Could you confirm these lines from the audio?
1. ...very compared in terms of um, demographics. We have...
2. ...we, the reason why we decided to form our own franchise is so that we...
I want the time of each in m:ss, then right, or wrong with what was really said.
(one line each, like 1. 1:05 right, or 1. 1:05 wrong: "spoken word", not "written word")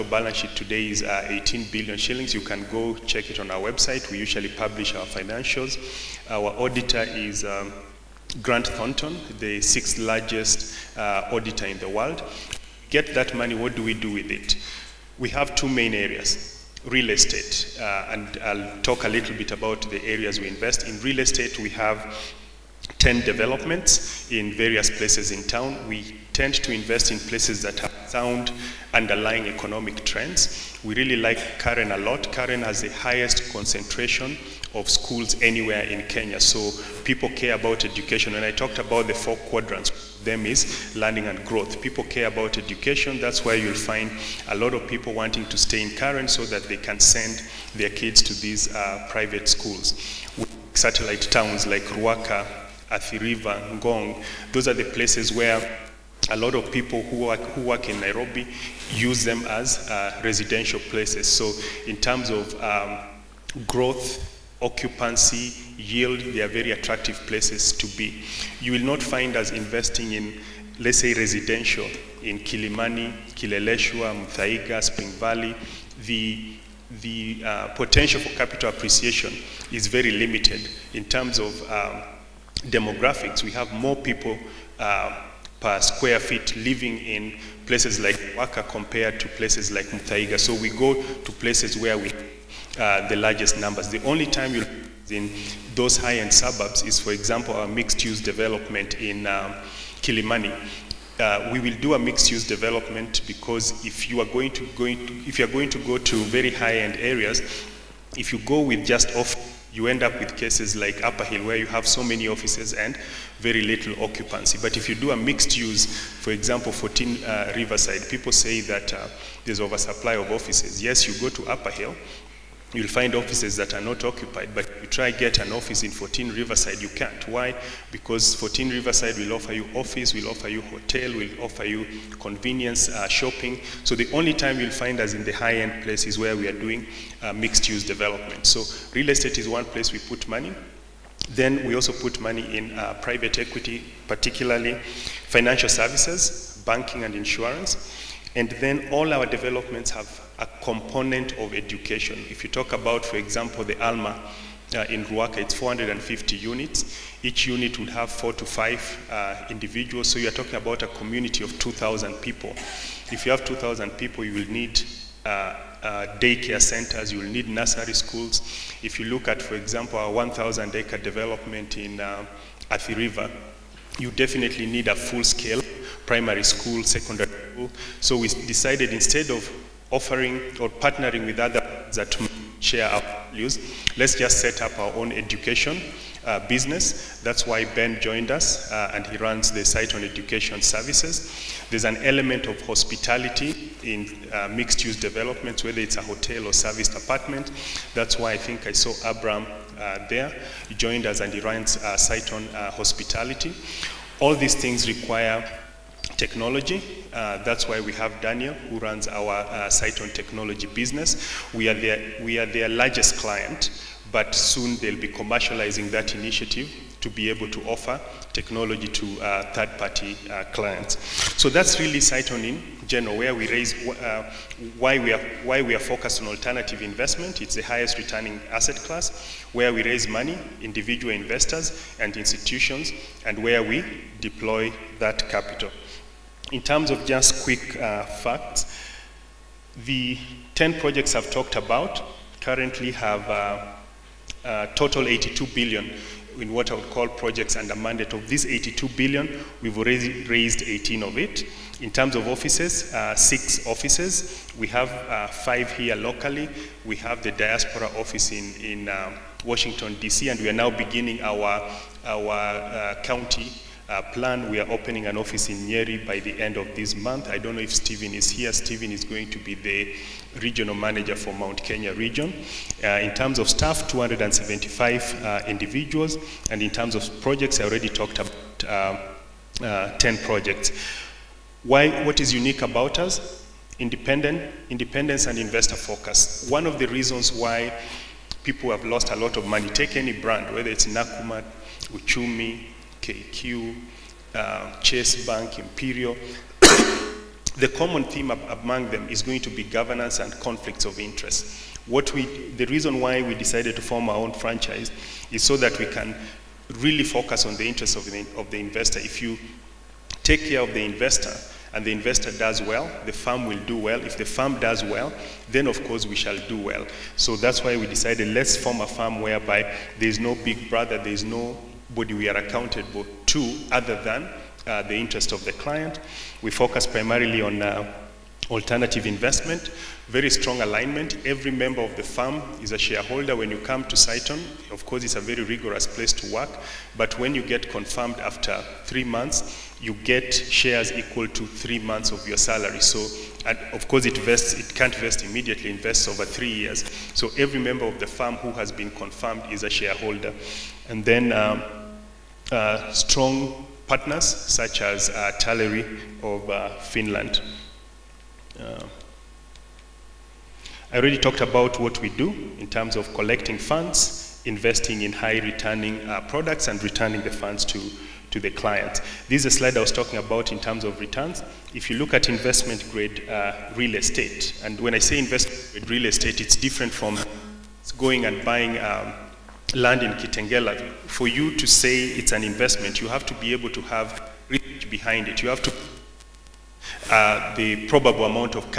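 1. 1:19 wrong: "limited", not "compared"
2. 5:02 right.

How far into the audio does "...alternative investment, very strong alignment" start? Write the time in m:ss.
5:28.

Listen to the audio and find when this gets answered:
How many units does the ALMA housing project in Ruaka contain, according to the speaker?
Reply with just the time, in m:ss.
2:35.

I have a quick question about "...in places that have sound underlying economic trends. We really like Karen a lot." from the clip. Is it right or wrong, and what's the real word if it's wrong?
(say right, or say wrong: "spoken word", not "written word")
right.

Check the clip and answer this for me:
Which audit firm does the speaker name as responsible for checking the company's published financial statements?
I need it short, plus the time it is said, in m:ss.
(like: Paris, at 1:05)
Grant Thornton, at 0:08.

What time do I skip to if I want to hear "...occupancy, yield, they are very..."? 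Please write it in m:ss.
1:04.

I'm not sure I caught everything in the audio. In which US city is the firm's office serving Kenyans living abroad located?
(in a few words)
Washington, D.C.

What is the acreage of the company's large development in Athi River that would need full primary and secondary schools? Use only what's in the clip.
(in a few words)
1,000 acres.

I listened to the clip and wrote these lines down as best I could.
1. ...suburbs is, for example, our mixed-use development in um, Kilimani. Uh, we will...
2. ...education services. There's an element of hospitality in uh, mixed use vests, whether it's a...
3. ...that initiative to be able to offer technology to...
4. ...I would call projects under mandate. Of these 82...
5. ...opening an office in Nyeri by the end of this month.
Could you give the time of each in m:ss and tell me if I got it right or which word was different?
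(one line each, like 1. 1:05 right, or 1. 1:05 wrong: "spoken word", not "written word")
1. 1:36 right
2. 3:10 wrong: "developments", not "vests"
3. 3:35 right
4. 4:06 right
5. 4:24 right.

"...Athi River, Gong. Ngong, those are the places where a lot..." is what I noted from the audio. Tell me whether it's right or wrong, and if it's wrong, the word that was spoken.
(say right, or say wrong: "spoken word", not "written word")
right.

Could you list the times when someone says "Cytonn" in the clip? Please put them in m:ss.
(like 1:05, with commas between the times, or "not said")
3:09, 3:21, 3:29, 3:41, 5:33.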